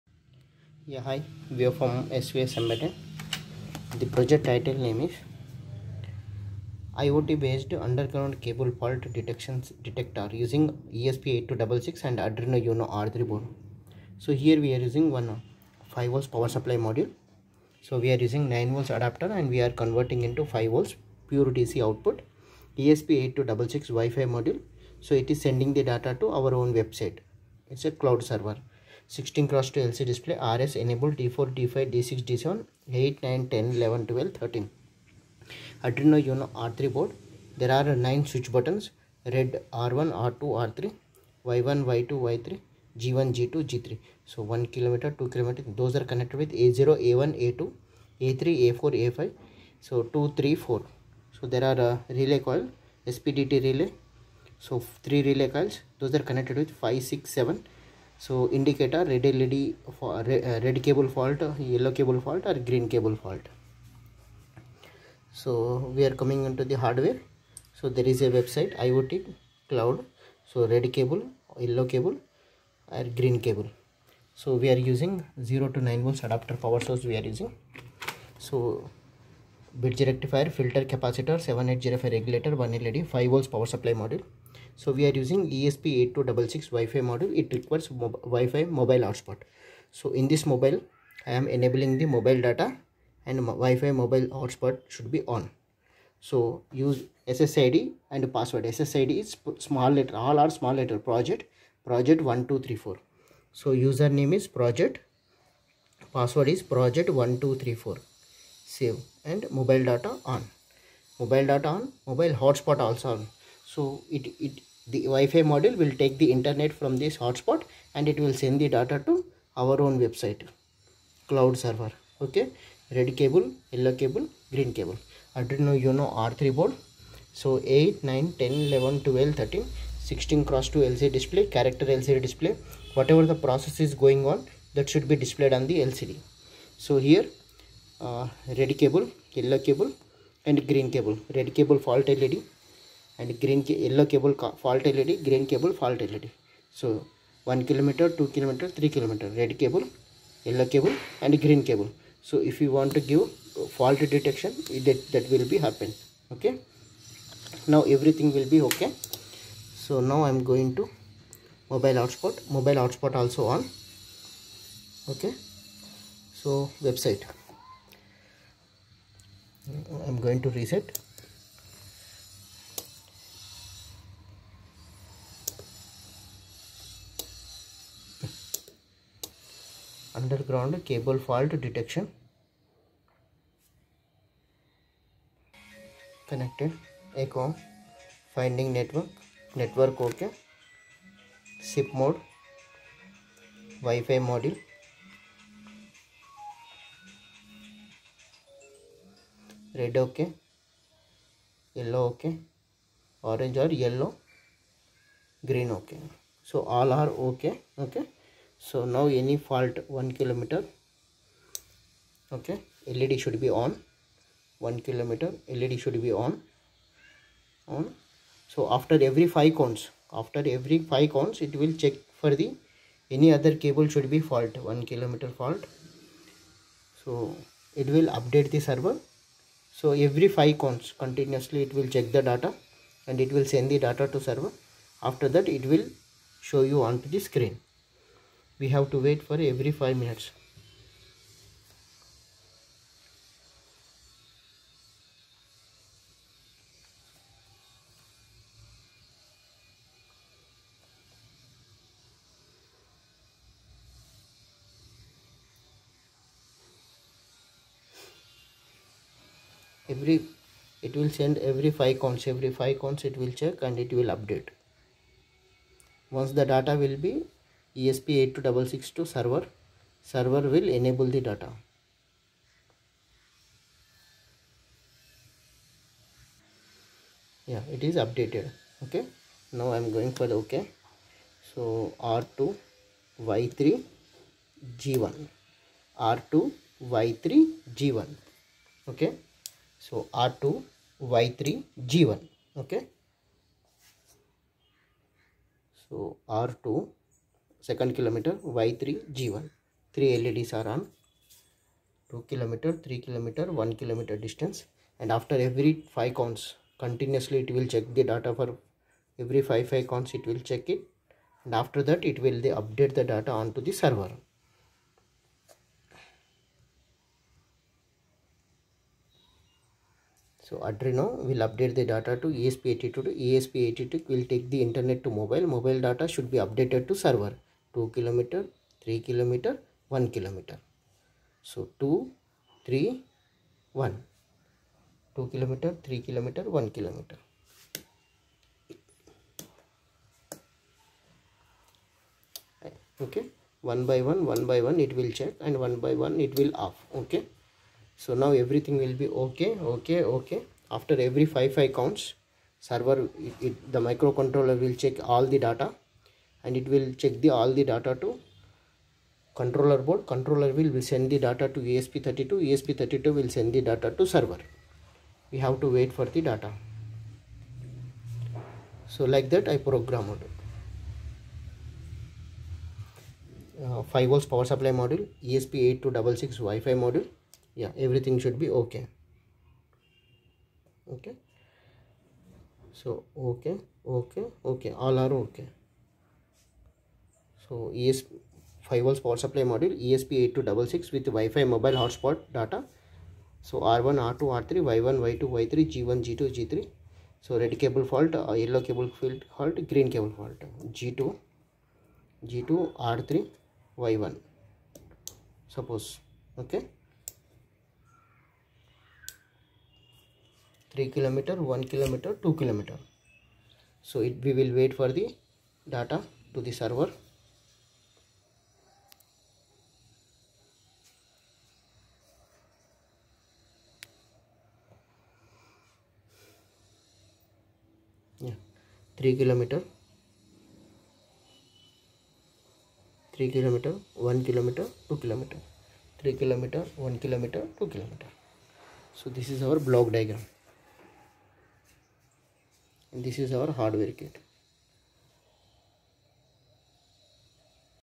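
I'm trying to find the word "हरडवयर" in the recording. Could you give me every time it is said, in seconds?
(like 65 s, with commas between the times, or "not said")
443 s.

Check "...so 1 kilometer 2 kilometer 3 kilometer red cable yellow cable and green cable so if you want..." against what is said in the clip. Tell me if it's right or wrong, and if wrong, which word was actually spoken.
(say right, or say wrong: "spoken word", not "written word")
right.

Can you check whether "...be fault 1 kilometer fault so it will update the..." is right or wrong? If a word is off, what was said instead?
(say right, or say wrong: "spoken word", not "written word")
right.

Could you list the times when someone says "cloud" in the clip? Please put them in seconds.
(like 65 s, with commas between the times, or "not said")
27 s, 69 s, 121 s.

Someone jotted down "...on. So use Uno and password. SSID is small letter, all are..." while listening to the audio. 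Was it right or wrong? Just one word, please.
wrong.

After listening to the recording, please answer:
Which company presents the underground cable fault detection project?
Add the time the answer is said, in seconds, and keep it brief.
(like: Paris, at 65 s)
SVS Embedded, at 2 s.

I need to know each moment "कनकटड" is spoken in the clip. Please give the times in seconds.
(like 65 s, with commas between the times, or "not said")
46 s, 56 s.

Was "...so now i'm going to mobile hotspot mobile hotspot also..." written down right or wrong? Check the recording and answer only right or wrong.
right.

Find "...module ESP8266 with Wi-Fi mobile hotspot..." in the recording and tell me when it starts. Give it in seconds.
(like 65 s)
389 s.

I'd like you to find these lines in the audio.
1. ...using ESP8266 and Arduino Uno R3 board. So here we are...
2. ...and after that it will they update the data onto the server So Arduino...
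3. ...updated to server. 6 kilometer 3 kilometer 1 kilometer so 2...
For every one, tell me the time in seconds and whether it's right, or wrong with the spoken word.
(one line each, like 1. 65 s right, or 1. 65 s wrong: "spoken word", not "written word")
1. 10 s right
2. 311 s right
3. 326 s wrong: "2", not "6".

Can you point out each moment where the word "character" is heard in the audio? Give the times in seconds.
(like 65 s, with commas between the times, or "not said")
131 s.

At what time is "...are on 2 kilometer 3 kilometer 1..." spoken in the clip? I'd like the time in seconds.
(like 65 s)
300 s.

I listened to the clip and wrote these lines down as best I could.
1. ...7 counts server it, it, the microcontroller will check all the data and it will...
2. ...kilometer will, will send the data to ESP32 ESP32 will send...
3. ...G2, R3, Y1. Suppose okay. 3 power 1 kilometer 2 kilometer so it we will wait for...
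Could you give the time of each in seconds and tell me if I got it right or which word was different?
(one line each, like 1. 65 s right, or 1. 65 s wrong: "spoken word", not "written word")
1. 351 s wrong: "5", not "7"
2. 360 s wrong: "controller", not "kilometer"
3. 402 s wrong: "kilometer", not "power".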